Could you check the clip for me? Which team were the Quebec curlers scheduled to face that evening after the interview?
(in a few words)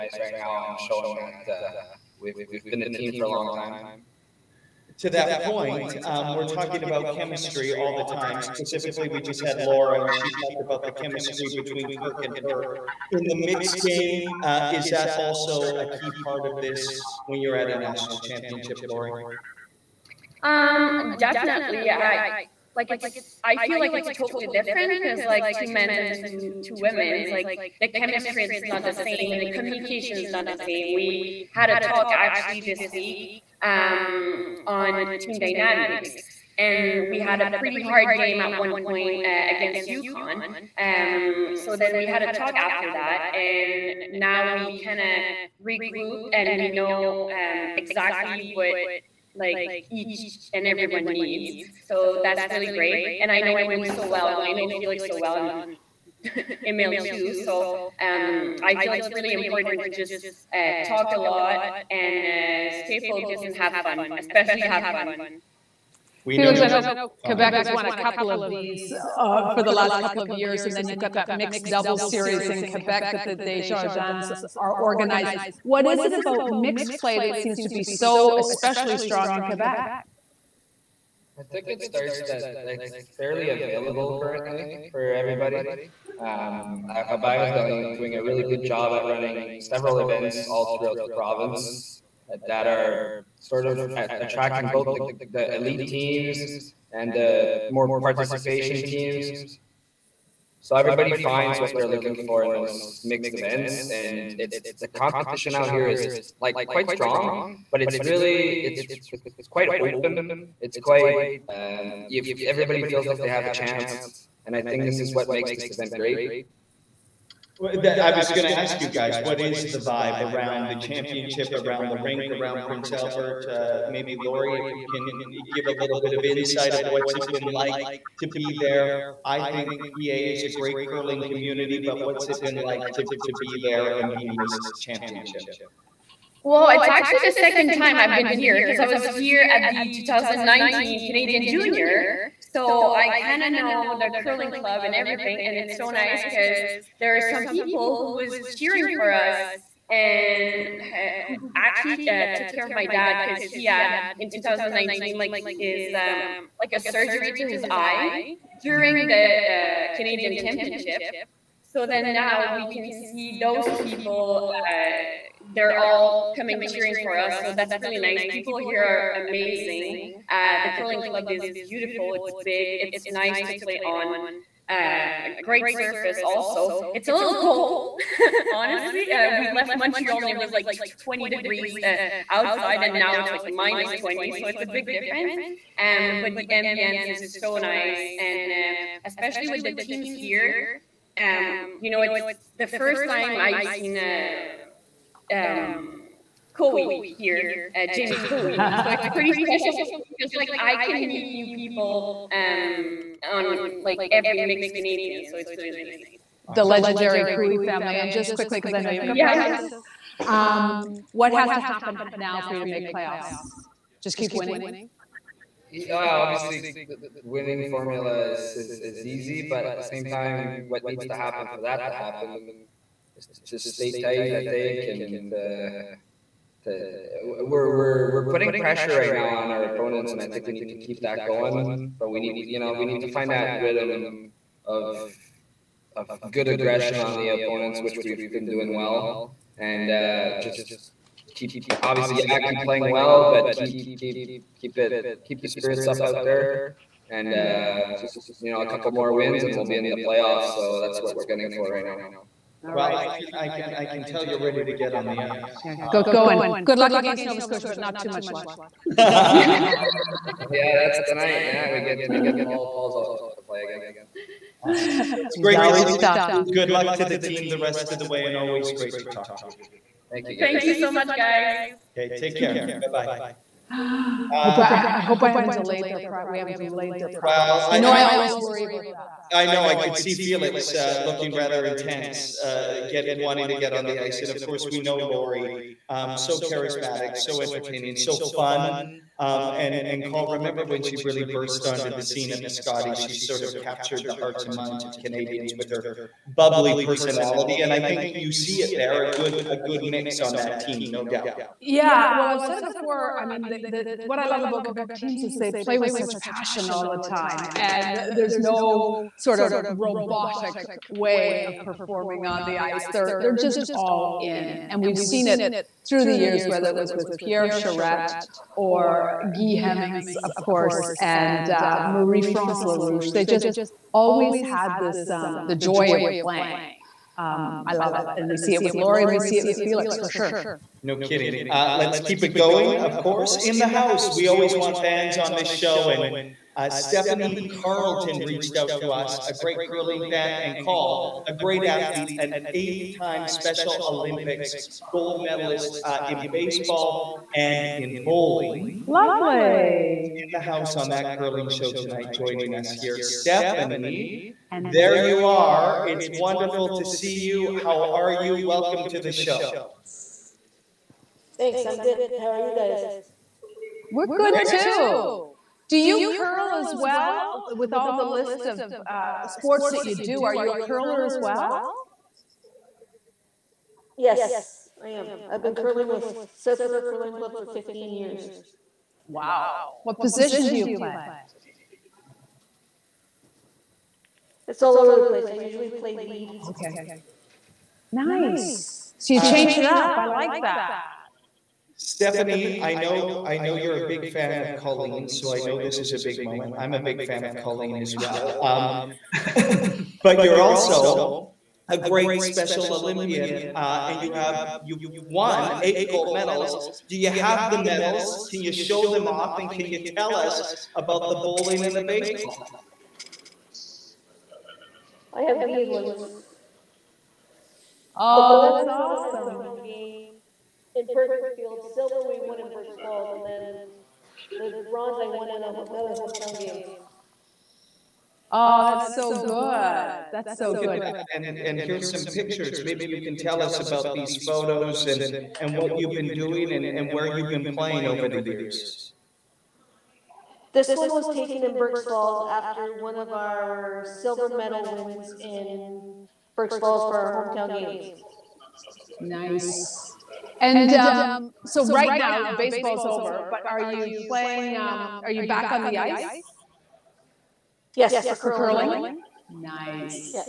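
Nova Scotia.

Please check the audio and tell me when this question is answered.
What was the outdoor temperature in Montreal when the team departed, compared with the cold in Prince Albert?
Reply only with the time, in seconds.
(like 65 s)
181 s.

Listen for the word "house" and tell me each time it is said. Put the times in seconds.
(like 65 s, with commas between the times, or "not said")
333 s, 350 s.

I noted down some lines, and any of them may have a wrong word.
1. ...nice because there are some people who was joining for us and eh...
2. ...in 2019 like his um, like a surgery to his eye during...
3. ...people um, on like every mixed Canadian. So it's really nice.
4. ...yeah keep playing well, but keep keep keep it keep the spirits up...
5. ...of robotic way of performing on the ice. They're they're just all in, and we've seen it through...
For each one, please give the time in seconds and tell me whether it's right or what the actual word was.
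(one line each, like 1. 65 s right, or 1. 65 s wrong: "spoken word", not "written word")
1. 145 s wrong: "cheering", not "joining"
2. 154 s right
3. 201 s right
4. 242 s right
5. 309 s right.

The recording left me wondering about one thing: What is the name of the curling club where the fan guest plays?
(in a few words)
South River Curling Club.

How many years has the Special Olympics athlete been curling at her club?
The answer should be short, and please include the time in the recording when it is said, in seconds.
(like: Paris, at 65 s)
15, at 377 s.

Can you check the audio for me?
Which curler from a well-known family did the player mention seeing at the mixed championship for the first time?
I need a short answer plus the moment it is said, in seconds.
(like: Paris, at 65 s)
Jamie Koe, at 197 s.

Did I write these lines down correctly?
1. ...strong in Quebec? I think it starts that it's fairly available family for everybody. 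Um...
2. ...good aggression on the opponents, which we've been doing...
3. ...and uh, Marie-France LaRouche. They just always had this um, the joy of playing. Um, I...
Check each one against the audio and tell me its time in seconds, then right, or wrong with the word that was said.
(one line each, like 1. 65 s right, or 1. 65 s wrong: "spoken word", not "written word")
1. 78 s wrong: "currently", not "family"
2. 236 s right
3. 320 s right.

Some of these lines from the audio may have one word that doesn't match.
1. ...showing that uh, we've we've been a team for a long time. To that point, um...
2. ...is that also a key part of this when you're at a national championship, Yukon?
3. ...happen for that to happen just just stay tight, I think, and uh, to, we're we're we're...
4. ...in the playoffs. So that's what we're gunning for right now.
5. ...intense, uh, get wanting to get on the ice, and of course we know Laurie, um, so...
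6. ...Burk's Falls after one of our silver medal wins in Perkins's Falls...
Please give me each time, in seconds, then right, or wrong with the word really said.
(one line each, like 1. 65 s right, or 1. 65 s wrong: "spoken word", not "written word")
1. 0 s right
2. 14 s wrong: "Laurie", not "Yukon"
3. 221 s right
4. 249 s right
5. 281 s right
6. 441 s wrong: "Burk", not "Perkins".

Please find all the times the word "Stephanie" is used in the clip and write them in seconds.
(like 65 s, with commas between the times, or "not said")
336 s, 353 s, 391 s.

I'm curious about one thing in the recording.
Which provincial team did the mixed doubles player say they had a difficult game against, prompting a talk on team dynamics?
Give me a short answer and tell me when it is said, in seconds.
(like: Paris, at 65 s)
Yukon, at 39 s.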